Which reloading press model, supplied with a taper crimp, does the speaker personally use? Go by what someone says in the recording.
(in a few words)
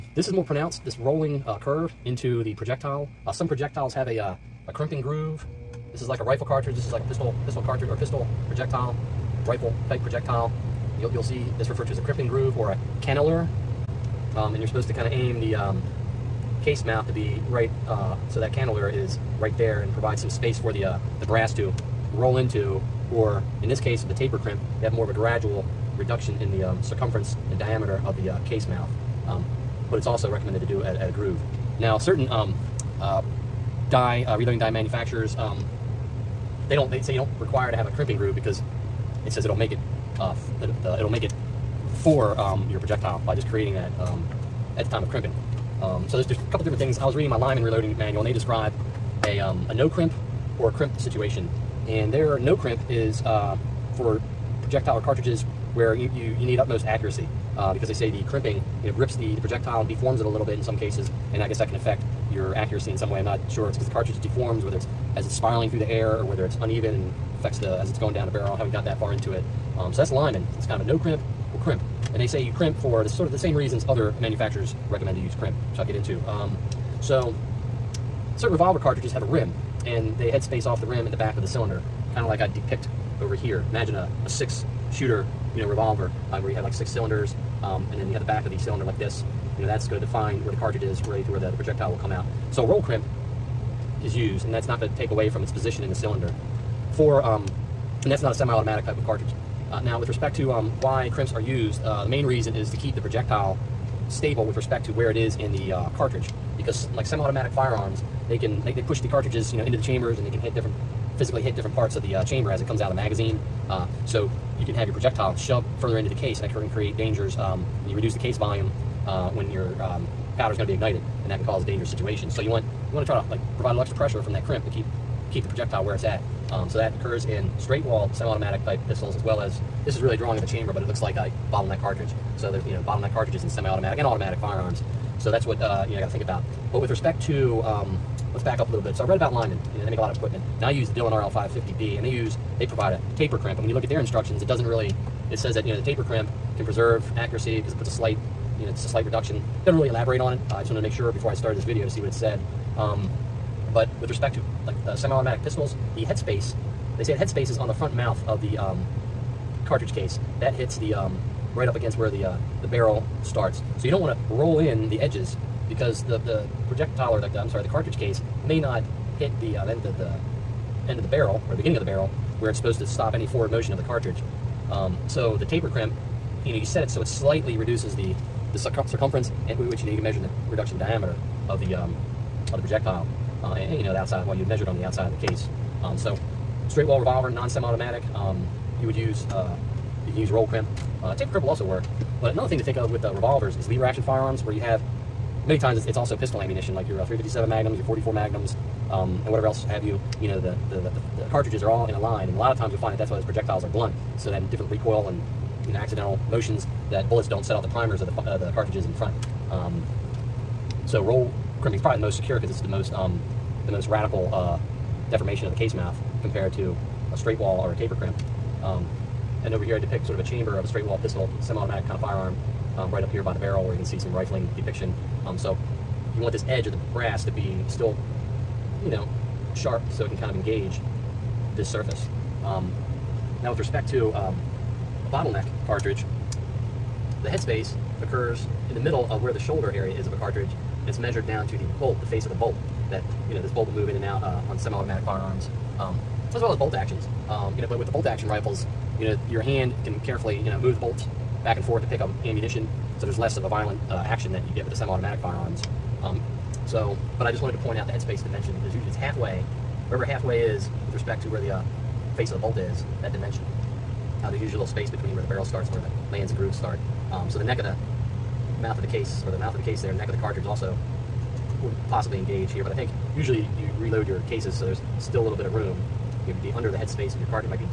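Dillon RL550B.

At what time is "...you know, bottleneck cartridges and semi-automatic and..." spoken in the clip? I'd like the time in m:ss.
2:12.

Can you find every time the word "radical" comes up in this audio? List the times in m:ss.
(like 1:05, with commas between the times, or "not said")
3:33.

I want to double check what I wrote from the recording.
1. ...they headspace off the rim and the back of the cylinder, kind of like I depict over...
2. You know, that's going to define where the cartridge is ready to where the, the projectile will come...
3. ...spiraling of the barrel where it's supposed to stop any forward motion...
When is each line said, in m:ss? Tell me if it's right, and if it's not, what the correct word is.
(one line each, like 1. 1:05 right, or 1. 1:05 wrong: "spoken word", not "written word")
1. 1:20 right
2. 1:29 right
3. 2:51 wrong: "beginning", not "spiraling".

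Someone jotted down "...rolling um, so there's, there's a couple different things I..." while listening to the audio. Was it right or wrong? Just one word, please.
wrong.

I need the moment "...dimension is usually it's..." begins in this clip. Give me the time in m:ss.
4:18.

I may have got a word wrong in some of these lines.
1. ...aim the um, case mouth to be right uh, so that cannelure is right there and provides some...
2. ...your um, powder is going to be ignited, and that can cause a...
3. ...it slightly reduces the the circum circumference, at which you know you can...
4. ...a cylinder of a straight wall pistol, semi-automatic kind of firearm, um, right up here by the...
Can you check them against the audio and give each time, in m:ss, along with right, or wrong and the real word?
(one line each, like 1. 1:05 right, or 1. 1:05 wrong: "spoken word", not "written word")
1. 0:15 right
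2. 1:59 right
3. 2:57 right
4. 3:40 wrong: "chamber", not "cylinder".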